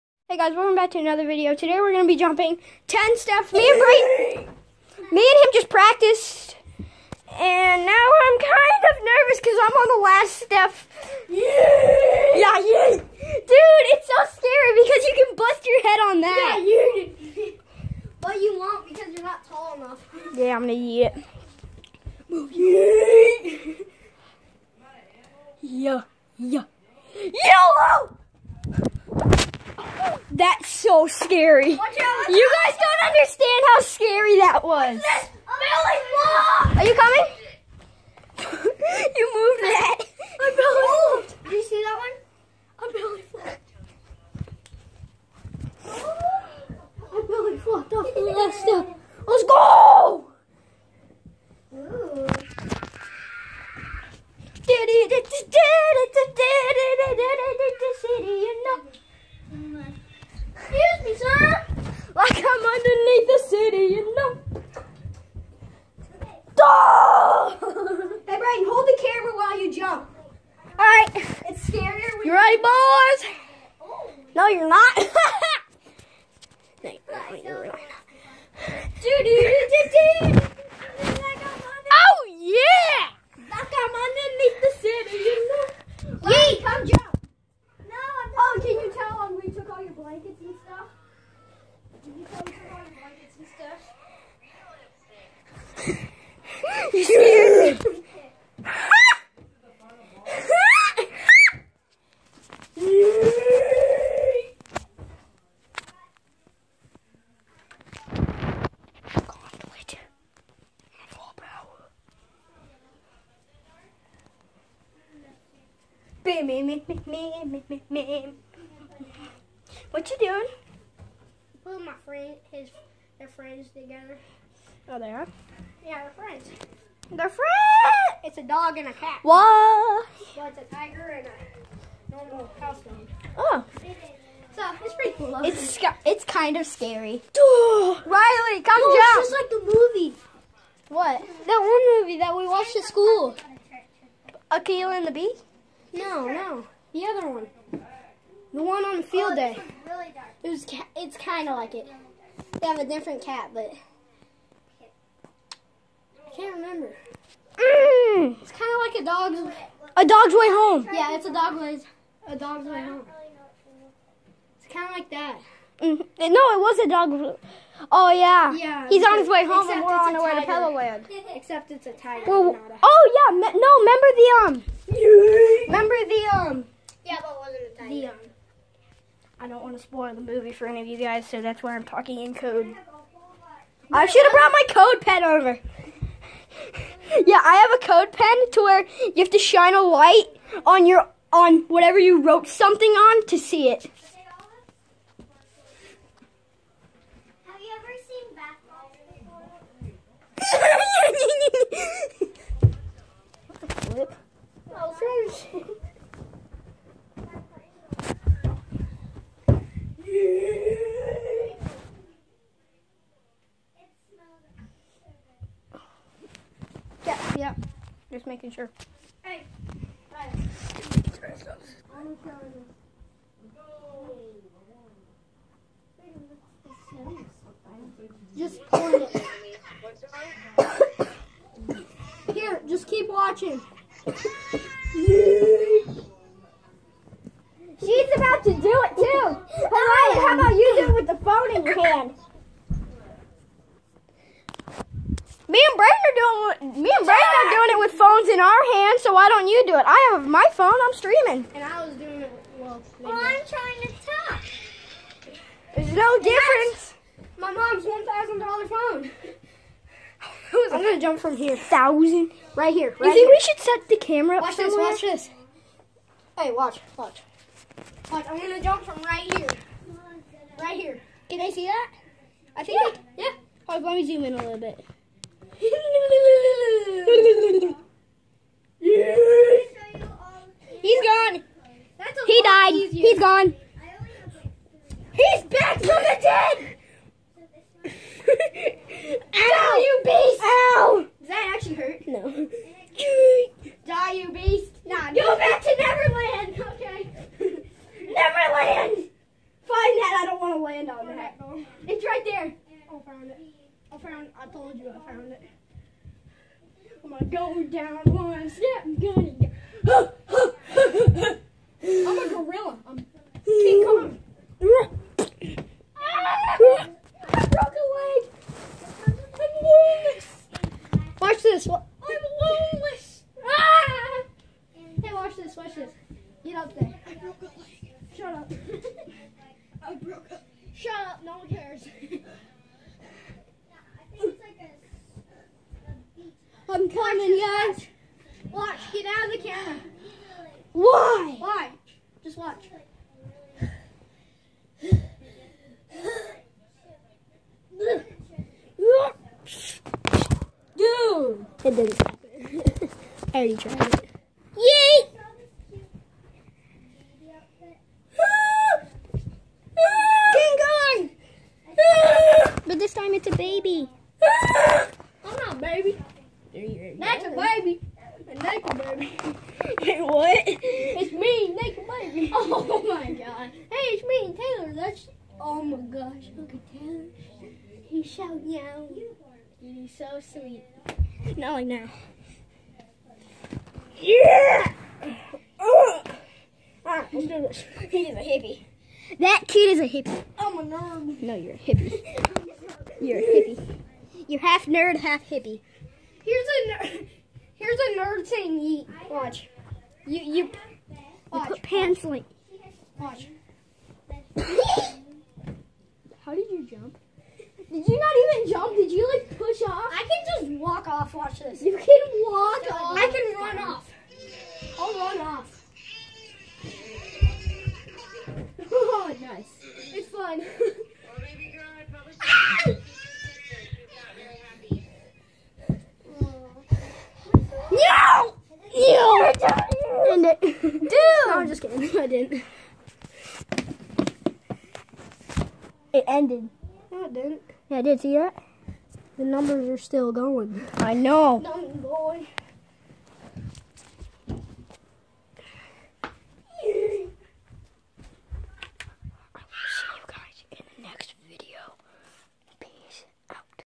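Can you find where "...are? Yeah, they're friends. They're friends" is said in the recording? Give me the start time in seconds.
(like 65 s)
125 s.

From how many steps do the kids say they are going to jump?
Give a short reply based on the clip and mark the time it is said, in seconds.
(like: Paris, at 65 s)
10, at 2 s.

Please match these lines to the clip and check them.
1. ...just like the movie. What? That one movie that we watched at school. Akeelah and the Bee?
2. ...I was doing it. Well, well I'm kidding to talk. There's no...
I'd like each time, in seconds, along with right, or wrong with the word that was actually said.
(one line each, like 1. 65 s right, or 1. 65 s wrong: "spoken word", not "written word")
1. 139 s right
2. 251 s wrong: "trying", not "kidding".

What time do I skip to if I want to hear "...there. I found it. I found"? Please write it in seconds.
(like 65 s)
302 s.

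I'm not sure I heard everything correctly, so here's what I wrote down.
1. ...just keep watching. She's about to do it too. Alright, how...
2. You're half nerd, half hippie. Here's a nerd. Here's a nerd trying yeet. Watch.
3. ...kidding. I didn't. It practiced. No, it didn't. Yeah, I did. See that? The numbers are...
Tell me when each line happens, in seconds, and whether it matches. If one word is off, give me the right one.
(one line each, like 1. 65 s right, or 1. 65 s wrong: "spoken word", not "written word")
1. 232 s right
2. 394 s wrong: "saying", not "trying"
3. 431 s wrong: "ended", not "practiced".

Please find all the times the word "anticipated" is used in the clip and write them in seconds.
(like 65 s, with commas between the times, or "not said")
not said.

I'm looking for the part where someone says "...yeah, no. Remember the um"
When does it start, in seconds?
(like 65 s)
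173 s.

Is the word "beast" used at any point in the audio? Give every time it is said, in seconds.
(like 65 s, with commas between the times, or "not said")
290 s, 294 s.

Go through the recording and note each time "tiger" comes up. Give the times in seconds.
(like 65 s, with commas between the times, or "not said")
130 s, 171 s, 177 s.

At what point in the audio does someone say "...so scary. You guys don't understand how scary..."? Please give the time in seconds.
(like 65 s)
30 s.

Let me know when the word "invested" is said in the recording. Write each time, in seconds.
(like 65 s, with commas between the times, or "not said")
not said.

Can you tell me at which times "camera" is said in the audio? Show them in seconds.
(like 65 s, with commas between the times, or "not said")
263 s, 339 s.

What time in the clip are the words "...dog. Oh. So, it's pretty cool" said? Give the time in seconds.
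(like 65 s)
132 s.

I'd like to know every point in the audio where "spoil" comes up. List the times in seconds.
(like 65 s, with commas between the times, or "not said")
179 s.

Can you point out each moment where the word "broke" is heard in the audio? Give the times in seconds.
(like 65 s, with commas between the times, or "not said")
317 s, 327 s.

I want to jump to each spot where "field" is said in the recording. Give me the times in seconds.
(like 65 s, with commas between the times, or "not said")
149 s.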